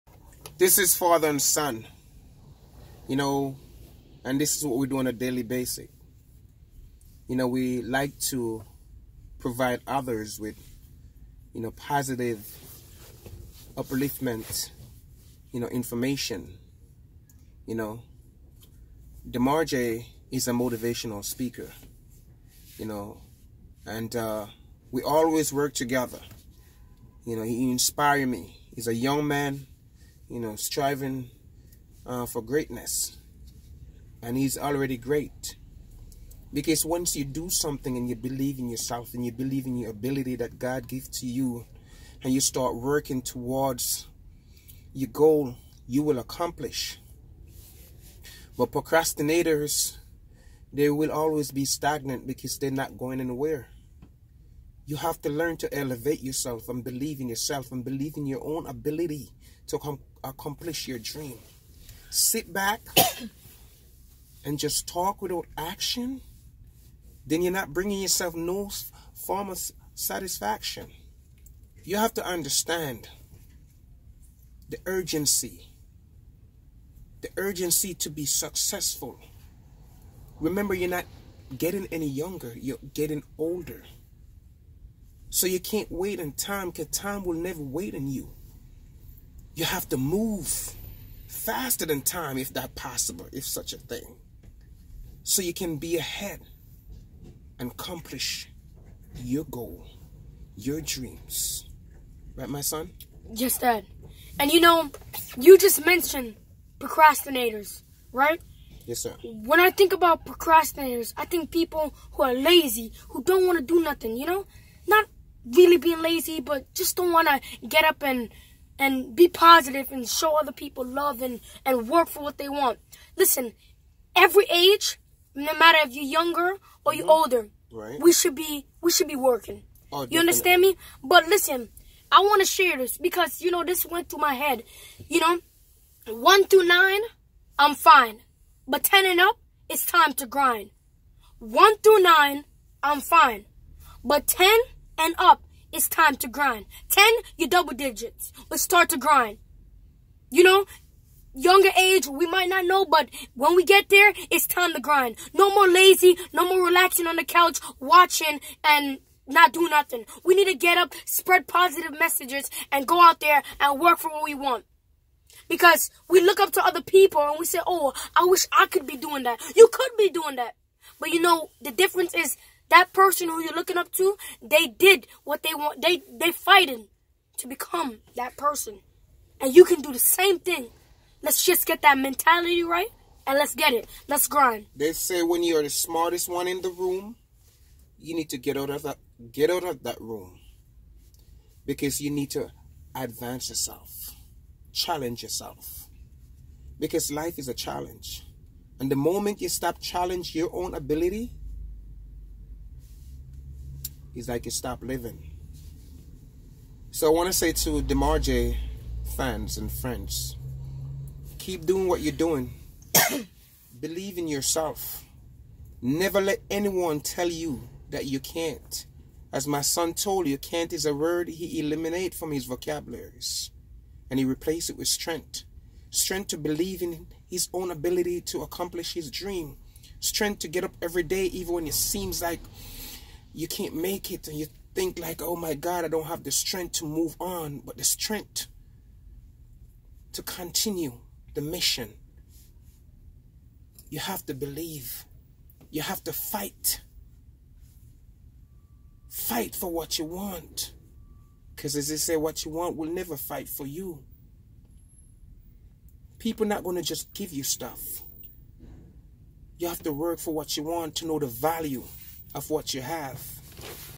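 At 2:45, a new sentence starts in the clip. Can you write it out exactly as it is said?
Because we look up to other people and we say, oh, I wish I could be doing that.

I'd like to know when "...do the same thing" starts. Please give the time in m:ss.
2:59.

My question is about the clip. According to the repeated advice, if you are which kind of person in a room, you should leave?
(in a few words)
The smartest one.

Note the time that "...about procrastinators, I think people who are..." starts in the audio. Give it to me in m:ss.
1:49.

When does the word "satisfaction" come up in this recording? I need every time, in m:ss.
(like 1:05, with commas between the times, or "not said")
1:09.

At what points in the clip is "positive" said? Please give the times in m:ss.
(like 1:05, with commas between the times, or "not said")
0:11, 1:59, 2:41.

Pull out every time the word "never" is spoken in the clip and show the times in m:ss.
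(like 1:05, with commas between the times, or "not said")
1:27, 3:35, 4:12.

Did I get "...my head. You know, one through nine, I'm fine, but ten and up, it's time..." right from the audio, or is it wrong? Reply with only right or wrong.
right.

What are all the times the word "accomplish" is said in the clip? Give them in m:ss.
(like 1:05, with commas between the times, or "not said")
0:46, 1:00, 1:37, 3:48.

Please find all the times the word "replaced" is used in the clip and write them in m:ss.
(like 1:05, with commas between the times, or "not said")
3:44.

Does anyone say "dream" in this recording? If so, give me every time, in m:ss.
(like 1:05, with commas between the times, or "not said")
1:00, 1:40, 3:49.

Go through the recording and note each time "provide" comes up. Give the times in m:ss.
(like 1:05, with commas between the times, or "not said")
0:09.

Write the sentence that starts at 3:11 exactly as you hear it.
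Because you need to advance yourself.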